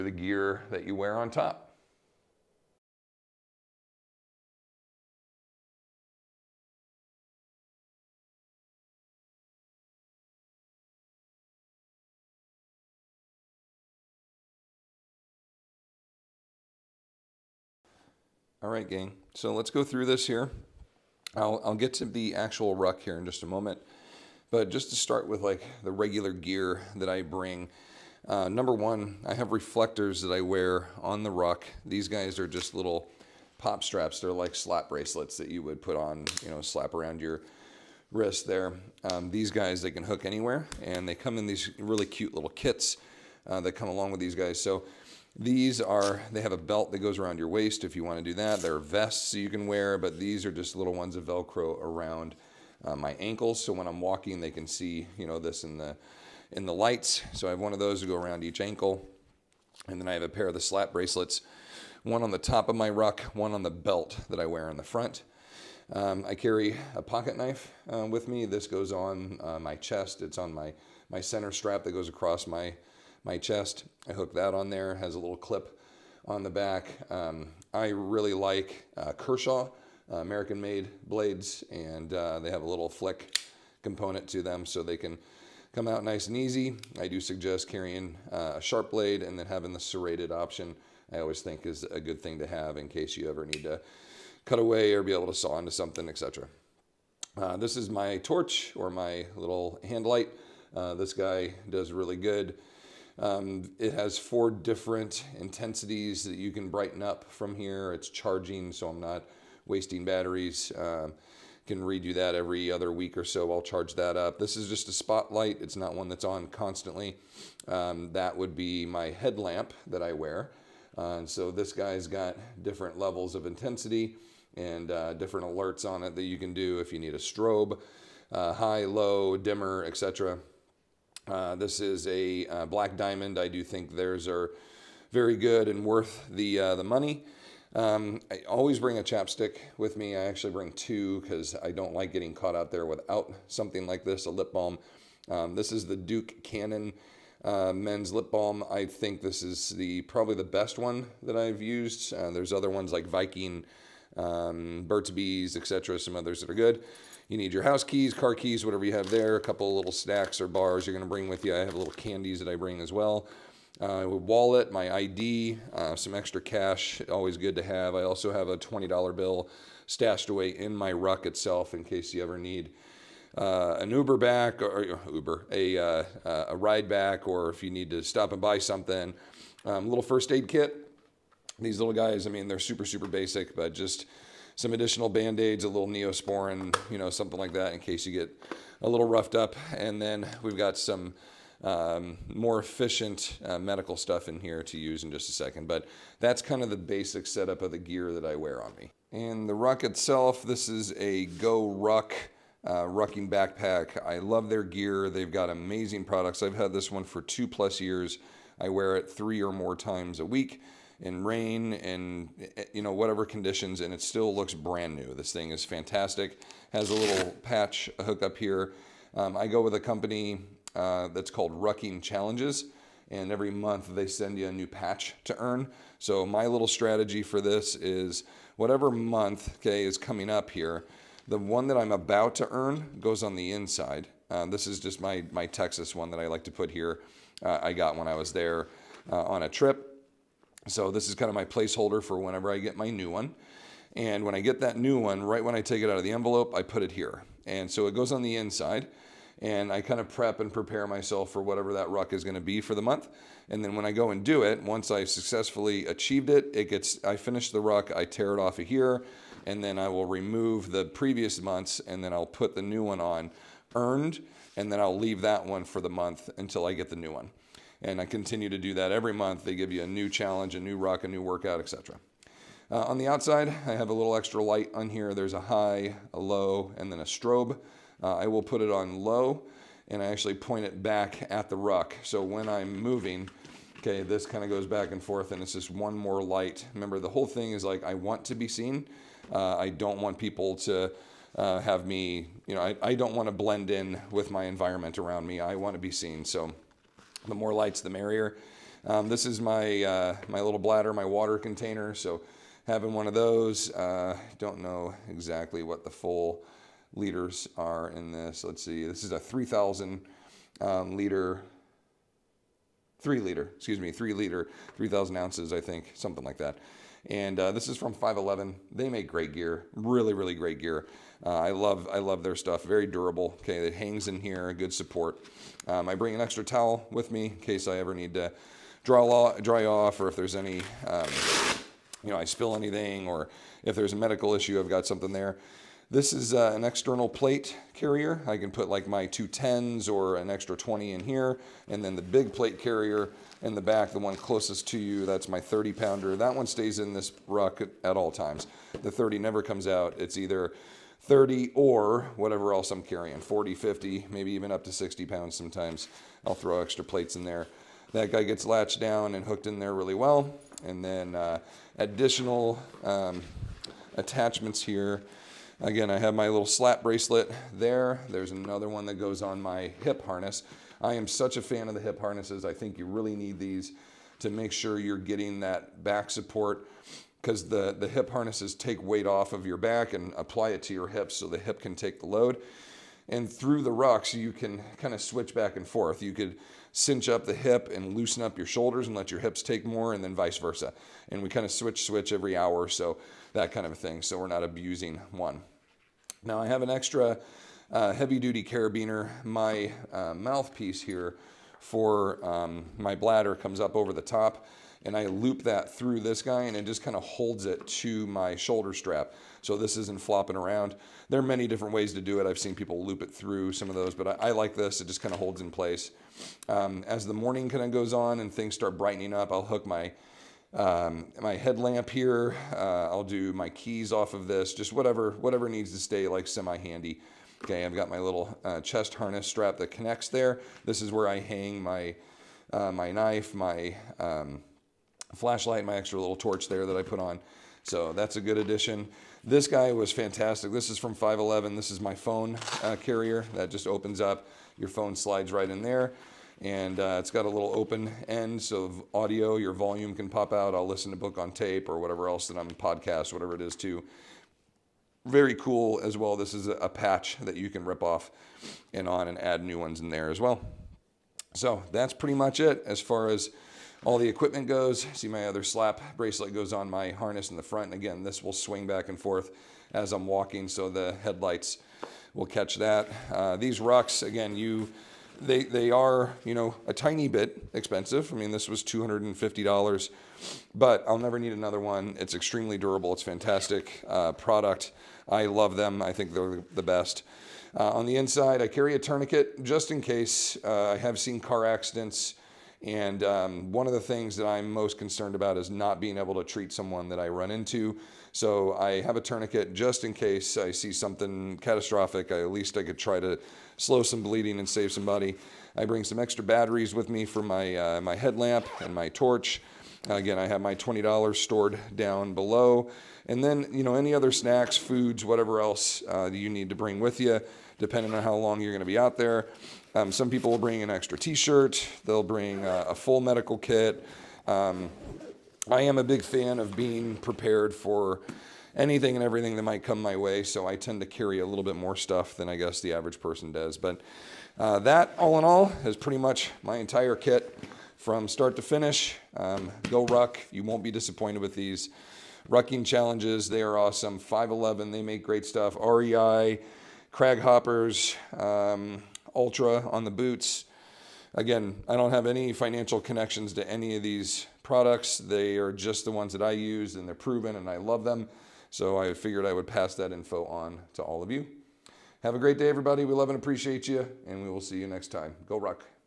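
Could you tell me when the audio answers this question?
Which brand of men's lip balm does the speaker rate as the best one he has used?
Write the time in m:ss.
2:25.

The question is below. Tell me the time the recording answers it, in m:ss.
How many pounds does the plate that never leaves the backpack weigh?
5:45.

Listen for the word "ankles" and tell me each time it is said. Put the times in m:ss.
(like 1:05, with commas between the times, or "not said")
0:53, 0:58.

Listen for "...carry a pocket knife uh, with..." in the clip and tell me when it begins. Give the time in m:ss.
1:06.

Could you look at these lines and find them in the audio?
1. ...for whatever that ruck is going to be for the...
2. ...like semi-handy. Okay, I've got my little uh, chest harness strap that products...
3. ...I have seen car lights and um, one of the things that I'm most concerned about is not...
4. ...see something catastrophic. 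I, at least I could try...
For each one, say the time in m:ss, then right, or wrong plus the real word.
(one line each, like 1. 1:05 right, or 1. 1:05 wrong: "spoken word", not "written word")
1. 4:11 right
2. 7:06 wrong: "connects", not "products"
3. 8:10 wrong: "accidents", not "lights"
4. 8:20 right.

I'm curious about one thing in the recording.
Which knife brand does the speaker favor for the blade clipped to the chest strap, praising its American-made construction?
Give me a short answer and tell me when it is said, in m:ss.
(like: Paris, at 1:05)
Kershaw, at 1:19.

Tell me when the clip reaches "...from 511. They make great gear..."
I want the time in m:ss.
5:17.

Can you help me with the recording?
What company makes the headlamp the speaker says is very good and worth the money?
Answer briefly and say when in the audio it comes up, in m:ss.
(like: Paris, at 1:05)
Black Diamond, at 2:12.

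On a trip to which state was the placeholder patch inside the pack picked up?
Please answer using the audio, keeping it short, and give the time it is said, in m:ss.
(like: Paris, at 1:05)
Texas, at 3:55.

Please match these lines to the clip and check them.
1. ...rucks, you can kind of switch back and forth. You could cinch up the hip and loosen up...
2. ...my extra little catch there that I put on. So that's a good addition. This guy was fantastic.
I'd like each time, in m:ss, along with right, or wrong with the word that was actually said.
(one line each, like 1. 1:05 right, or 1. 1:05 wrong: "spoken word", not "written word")
1. 6:23 right
2. 7:15 wrong: "torch", not "catch".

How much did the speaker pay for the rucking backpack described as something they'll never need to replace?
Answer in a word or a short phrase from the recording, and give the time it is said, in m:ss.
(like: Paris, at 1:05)
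$250, at 7:58.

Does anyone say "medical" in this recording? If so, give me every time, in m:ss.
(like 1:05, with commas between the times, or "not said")
3:13, 5:33, 8:43.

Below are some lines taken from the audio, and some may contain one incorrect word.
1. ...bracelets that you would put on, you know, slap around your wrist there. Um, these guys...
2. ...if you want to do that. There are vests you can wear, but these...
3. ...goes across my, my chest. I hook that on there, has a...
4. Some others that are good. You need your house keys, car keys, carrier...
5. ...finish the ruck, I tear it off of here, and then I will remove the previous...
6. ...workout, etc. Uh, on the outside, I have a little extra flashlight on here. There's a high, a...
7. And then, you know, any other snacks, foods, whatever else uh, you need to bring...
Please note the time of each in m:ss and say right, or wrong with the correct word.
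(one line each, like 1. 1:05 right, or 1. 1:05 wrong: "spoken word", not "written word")
1. 0:34 right
2. 0:47 right
3. 1:11 right
4. 2:35 wrong: "whatever", not "carrier"
5. 4:17 right
6. 4:31 wrong: "light", not "flashlight"
7. 8:33 right.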